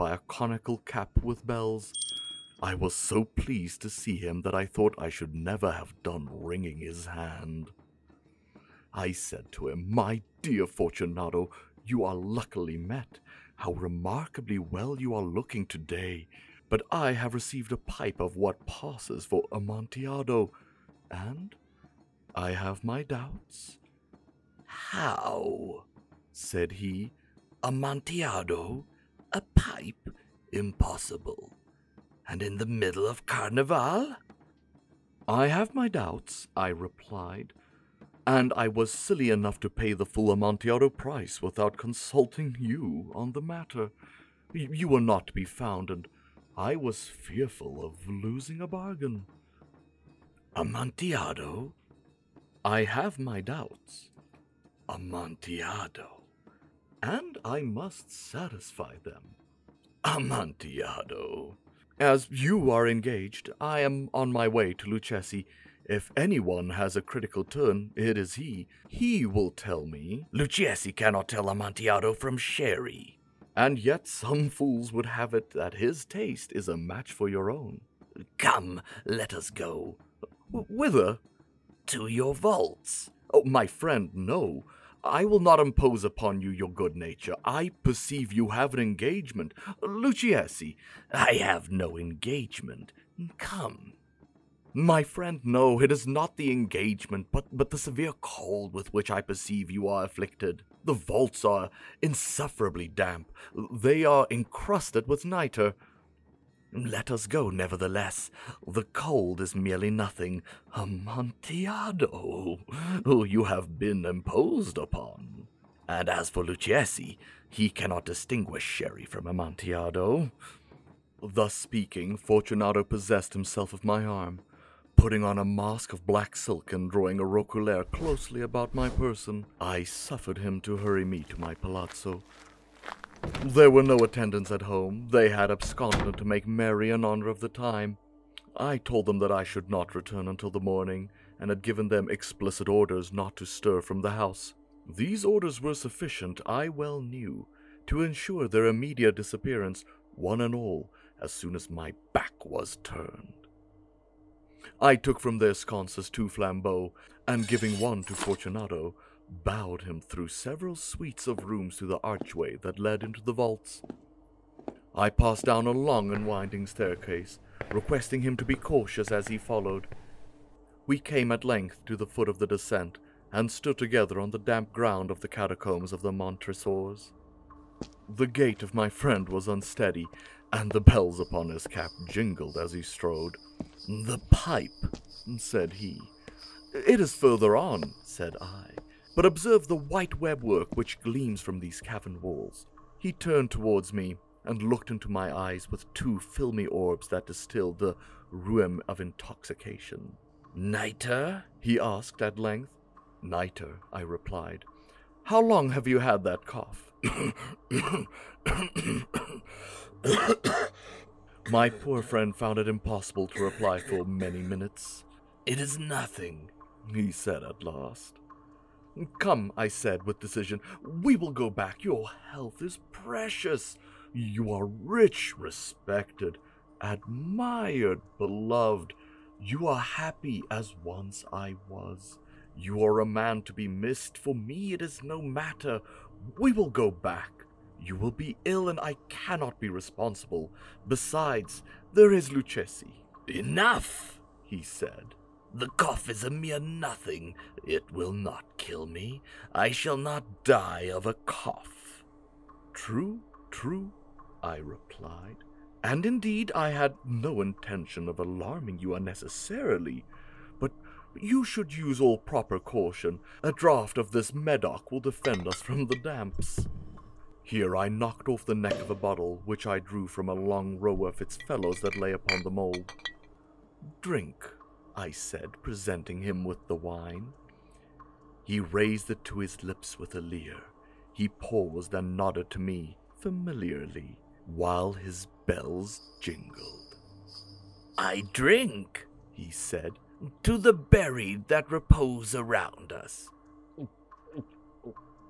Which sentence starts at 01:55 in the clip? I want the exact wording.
And as for Lucchesi, he cannot distinguish sherry from Amontillado.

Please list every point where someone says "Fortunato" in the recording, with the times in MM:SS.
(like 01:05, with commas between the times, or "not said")
00:10, 02:02, 02:38.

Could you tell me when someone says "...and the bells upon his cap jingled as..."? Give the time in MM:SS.
03:00.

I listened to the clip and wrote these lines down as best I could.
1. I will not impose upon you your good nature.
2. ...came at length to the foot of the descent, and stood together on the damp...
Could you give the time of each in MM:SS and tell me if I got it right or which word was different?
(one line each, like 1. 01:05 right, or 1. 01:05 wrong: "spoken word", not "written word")
1. 01:25 right
2. 02:50 right.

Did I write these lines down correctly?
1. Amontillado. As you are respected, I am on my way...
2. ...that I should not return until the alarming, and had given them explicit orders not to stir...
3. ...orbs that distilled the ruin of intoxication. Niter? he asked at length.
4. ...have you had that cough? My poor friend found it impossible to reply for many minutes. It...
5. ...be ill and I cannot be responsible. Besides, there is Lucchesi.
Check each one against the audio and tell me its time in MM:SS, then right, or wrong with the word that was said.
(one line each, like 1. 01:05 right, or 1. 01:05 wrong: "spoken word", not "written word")
1. 01:00 wrong: "engaged", not "respected"
2. 02:19 wrong: "morning", not "alarming"
3. 03:16 right
4. 03:25 right
5. 03:58 right.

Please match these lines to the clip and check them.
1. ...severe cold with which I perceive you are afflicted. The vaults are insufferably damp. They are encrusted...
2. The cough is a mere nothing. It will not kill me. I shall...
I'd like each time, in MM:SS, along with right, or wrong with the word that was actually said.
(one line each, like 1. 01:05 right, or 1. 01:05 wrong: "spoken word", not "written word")
1. 01:37 right
2. 04:05 right.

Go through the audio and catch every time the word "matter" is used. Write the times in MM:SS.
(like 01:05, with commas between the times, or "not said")
00:43, 03:55.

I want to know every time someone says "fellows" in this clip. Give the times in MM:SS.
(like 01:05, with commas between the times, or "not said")
04:31.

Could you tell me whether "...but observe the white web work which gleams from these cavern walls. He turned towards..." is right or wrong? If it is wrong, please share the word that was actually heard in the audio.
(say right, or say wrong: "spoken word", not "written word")
right.